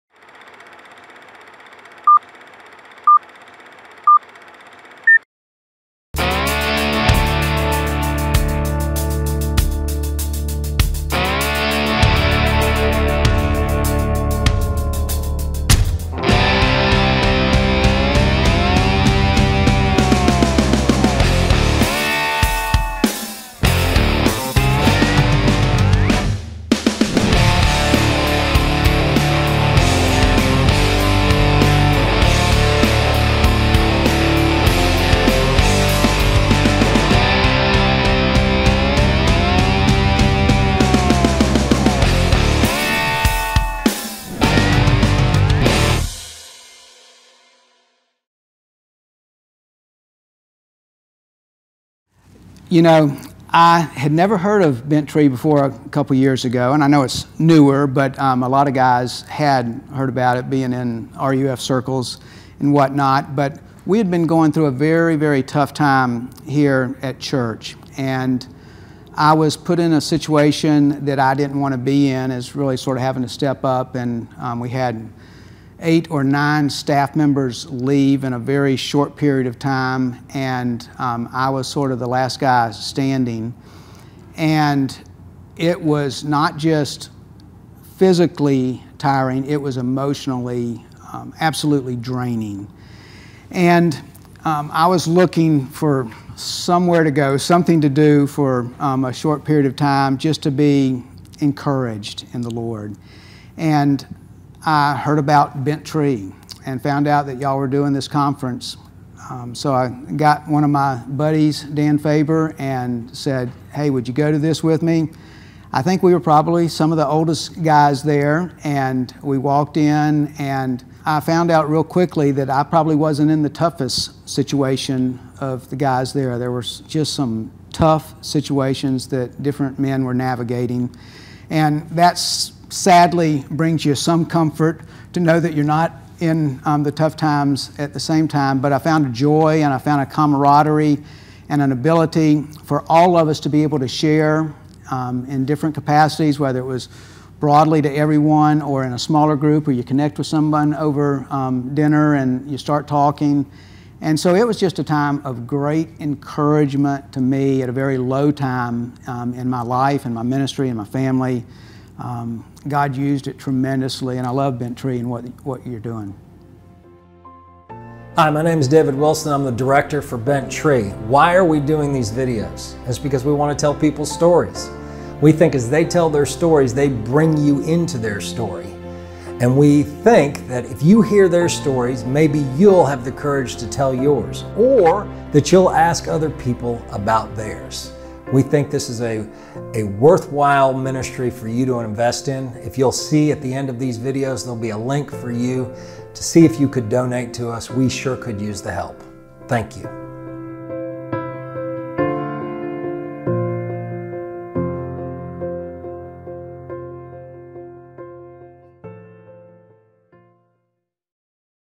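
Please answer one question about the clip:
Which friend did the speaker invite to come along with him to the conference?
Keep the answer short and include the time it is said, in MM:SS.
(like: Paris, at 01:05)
Dan Faber, at 01:51.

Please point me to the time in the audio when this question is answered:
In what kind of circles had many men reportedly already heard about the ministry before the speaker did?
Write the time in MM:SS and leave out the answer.
01:01.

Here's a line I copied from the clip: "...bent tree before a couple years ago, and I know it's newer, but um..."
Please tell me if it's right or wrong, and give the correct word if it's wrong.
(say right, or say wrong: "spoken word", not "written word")
right.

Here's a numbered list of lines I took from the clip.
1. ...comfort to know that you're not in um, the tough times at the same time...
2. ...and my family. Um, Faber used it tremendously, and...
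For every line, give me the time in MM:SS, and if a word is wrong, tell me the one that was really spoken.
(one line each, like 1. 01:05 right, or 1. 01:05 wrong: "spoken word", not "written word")
1. 02:14 right
2. 02:40 wrong: "God", not "Faber".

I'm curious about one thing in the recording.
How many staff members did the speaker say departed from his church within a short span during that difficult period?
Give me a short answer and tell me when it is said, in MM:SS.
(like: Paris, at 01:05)
8 or 9, at 01:15.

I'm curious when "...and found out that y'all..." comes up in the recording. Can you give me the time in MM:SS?
01:46.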